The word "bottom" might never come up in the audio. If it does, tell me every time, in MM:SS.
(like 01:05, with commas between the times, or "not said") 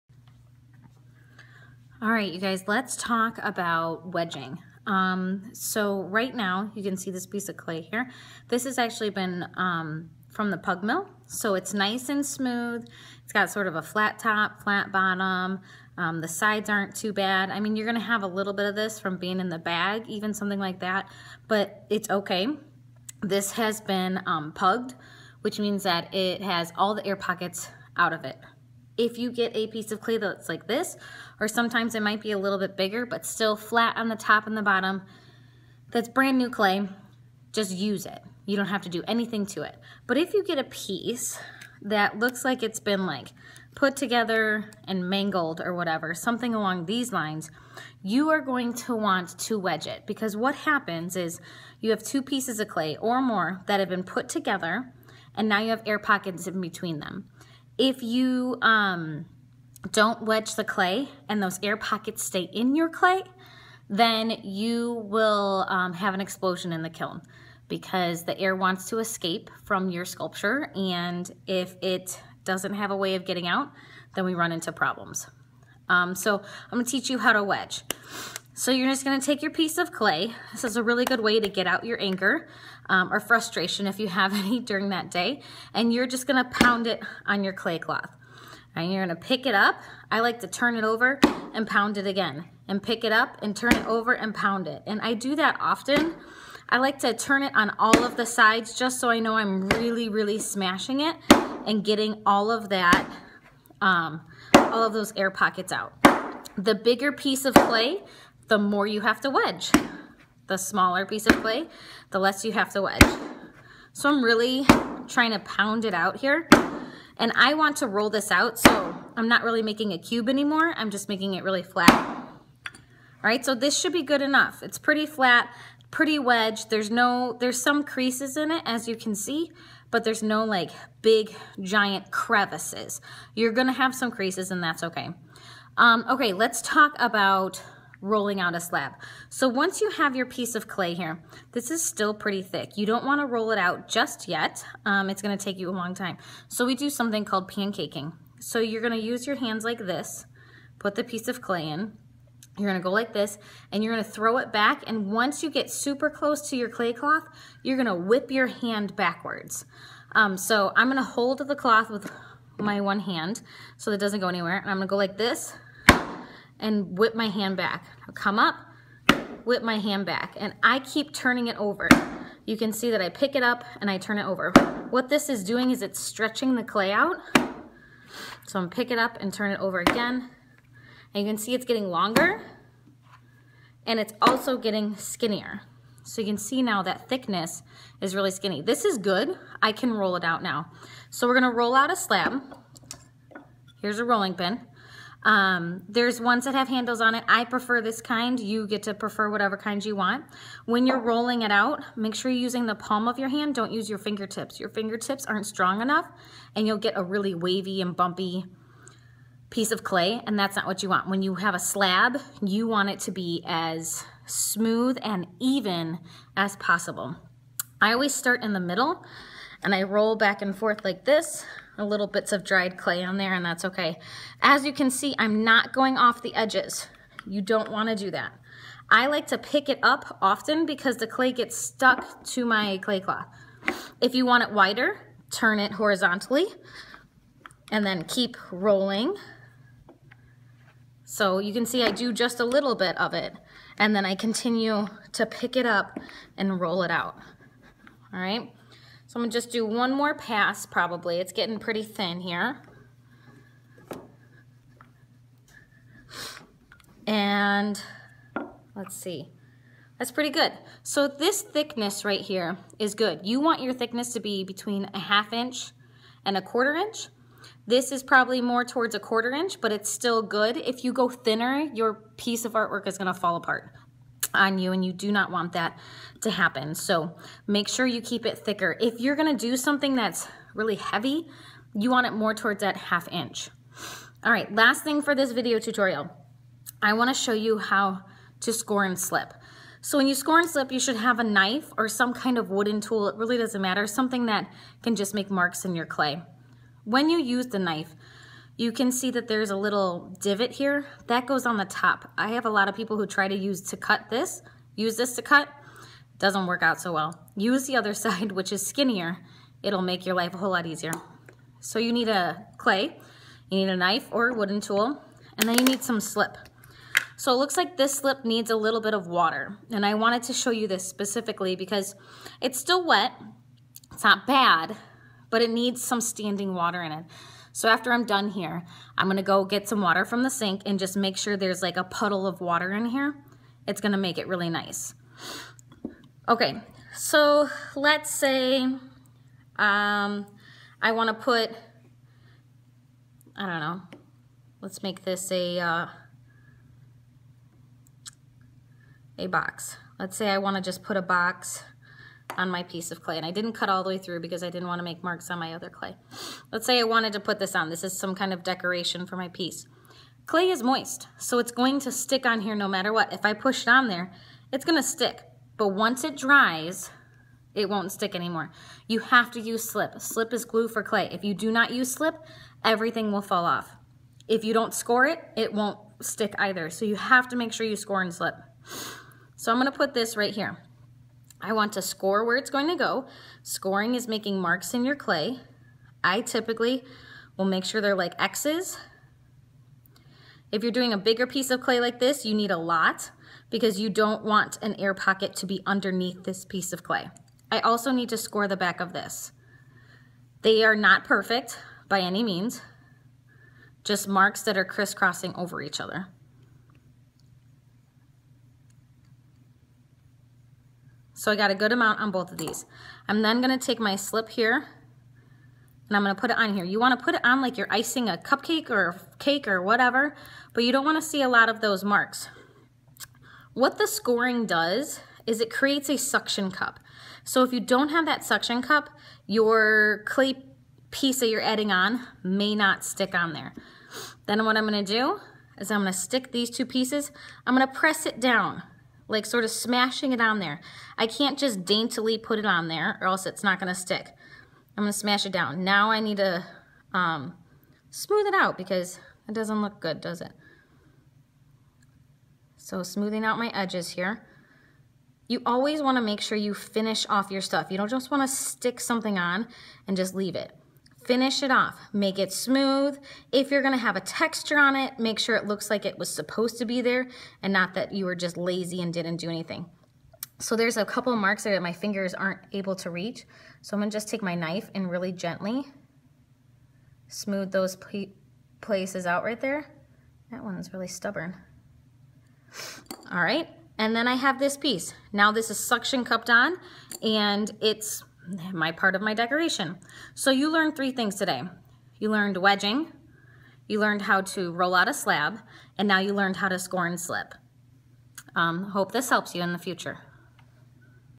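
00:14, 00:34.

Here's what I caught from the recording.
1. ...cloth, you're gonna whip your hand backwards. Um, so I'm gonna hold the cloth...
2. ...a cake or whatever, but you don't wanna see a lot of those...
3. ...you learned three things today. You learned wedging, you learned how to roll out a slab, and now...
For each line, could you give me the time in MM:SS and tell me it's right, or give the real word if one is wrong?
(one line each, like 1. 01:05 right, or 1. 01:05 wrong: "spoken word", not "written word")
1. 02:36 right
2. 06:59 right
3. 08:10 right.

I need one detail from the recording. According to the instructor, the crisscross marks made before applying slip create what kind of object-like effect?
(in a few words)
a suction cup.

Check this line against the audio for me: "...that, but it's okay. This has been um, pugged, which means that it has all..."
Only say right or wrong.
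right.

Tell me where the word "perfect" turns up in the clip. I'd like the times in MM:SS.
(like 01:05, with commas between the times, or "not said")
06:41.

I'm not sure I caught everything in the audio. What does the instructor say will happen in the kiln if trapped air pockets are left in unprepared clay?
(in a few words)
an explosion.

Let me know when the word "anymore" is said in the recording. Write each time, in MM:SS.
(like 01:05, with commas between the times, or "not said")
02:00, 06:08.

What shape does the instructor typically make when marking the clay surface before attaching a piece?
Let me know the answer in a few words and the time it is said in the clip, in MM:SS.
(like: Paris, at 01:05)
X's, at 06:28.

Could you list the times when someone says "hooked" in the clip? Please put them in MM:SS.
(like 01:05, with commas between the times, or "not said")
not said.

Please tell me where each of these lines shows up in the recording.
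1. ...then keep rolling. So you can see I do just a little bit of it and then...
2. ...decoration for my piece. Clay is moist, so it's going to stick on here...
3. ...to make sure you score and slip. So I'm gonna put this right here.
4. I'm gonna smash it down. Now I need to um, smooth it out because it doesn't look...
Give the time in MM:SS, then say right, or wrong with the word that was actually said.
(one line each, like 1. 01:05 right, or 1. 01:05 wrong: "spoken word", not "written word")
1. 03:57 right
2. 05:58 right
3. 06:17 right
4. 07:24 right.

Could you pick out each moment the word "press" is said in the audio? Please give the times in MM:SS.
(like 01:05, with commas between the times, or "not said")
07:17.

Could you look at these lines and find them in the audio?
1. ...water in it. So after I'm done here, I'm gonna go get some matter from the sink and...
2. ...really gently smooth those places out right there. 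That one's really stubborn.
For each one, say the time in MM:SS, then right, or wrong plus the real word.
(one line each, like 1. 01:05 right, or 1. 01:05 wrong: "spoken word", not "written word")
1. 05:26 wrong: "water", not "matter"
2. 07:54 right.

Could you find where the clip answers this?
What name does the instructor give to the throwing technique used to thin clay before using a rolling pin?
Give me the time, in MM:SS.
02:27.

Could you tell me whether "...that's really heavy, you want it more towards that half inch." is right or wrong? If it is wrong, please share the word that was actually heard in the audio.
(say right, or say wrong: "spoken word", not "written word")
right.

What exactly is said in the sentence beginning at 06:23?
Scoring is making marks in your clay.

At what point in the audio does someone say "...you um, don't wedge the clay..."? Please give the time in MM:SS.
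00:58.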